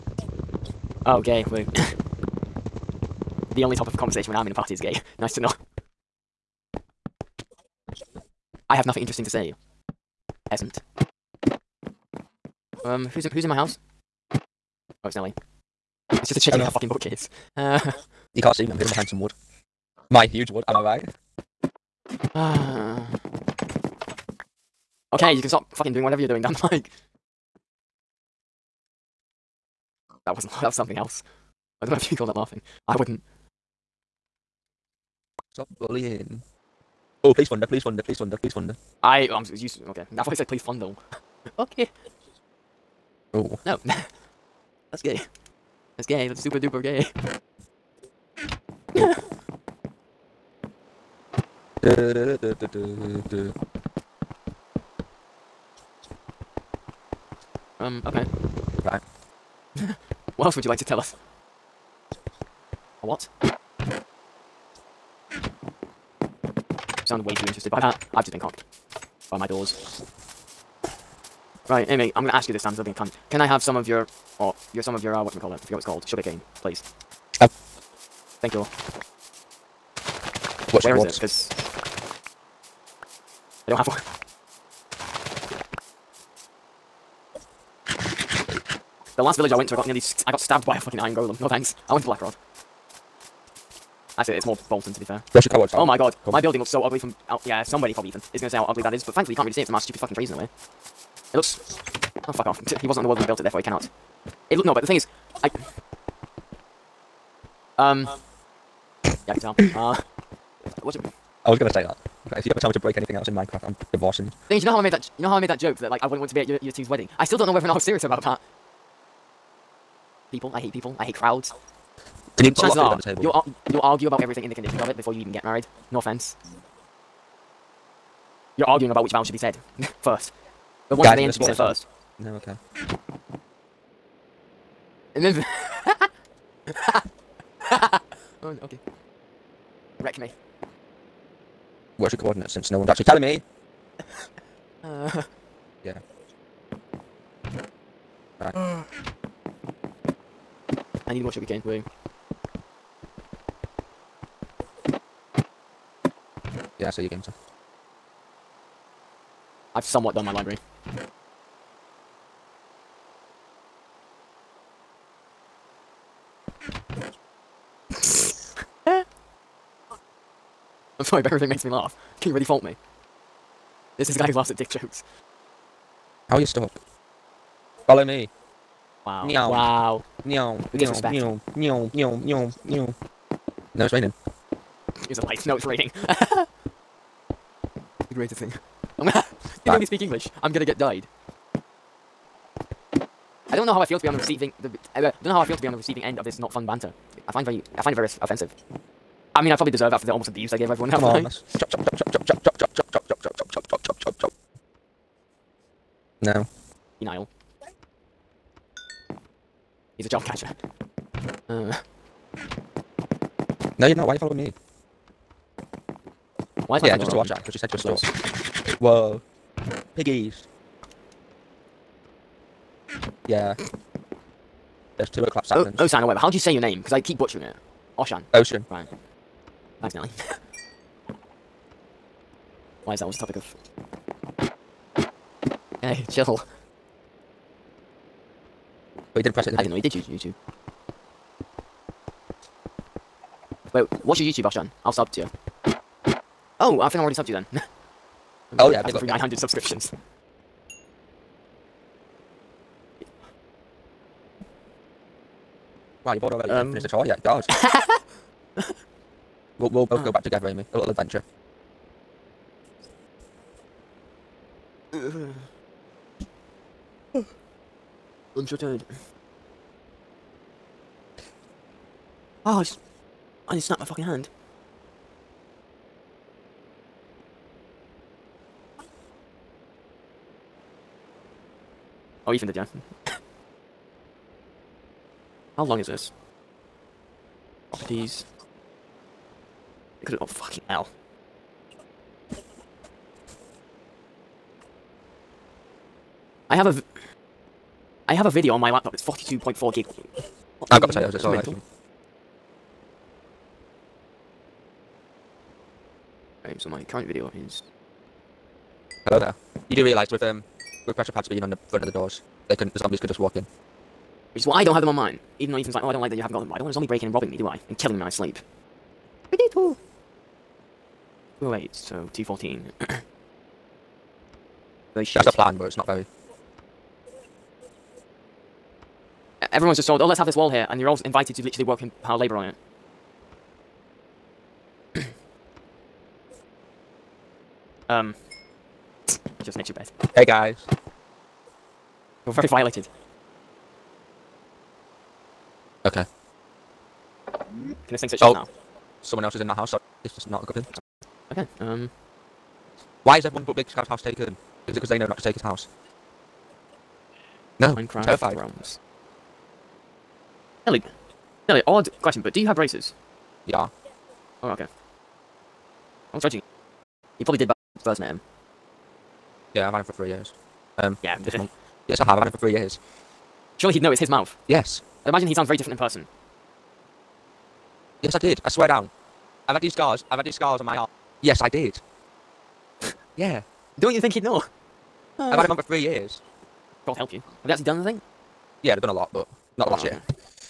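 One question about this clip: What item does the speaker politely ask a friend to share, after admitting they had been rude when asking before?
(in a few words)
Sugar cane.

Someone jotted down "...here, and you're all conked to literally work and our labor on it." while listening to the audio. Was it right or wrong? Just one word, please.
wrong.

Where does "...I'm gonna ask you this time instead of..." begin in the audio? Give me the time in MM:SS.
01:12.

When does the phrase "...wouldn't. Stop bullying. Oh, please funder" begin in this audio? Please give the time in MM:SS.
00:32.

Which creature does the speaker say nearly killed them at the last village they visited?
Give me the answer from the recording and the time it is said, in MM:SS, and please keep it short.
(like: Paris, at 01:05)
Iron golem, at 01:30.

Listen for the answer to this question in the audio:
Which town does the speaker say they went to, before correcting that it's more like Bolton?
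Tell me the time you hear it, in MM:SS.
01:32.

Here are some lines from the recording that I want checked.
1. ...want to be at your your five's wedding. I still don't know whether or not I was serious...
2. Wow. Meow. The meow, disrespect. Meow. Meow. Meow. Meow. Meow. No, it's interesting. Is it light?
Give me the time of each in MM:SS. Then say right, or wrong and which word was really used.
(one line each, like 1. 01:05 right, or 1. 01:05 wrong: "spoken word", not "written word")
1. 01:56 wrong: "two", not "five"
2. 02:59 wrong: "raining", not "interesting".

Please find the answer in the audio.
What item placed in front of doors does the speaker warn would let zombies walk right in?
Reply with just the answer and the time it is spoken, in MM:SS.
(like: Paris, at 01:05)
Pressure pads, at 05:10.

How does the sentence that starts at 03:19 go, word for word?
I mean, I probably deserve it after the almost abuse I gave everyone.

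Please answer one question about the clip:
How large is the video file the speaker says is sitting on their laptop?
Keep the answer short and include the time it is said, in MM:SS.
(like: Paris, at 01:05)
42.4 gig, at 04:59.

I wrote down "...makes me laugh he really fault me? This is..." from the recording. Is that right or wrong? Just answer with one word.
right.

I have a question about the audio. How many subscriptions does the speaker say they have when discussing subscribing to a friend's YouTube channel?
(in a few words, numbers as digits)
900.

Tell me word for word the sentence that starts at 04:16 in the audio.
Um, haven't finished the tour yet?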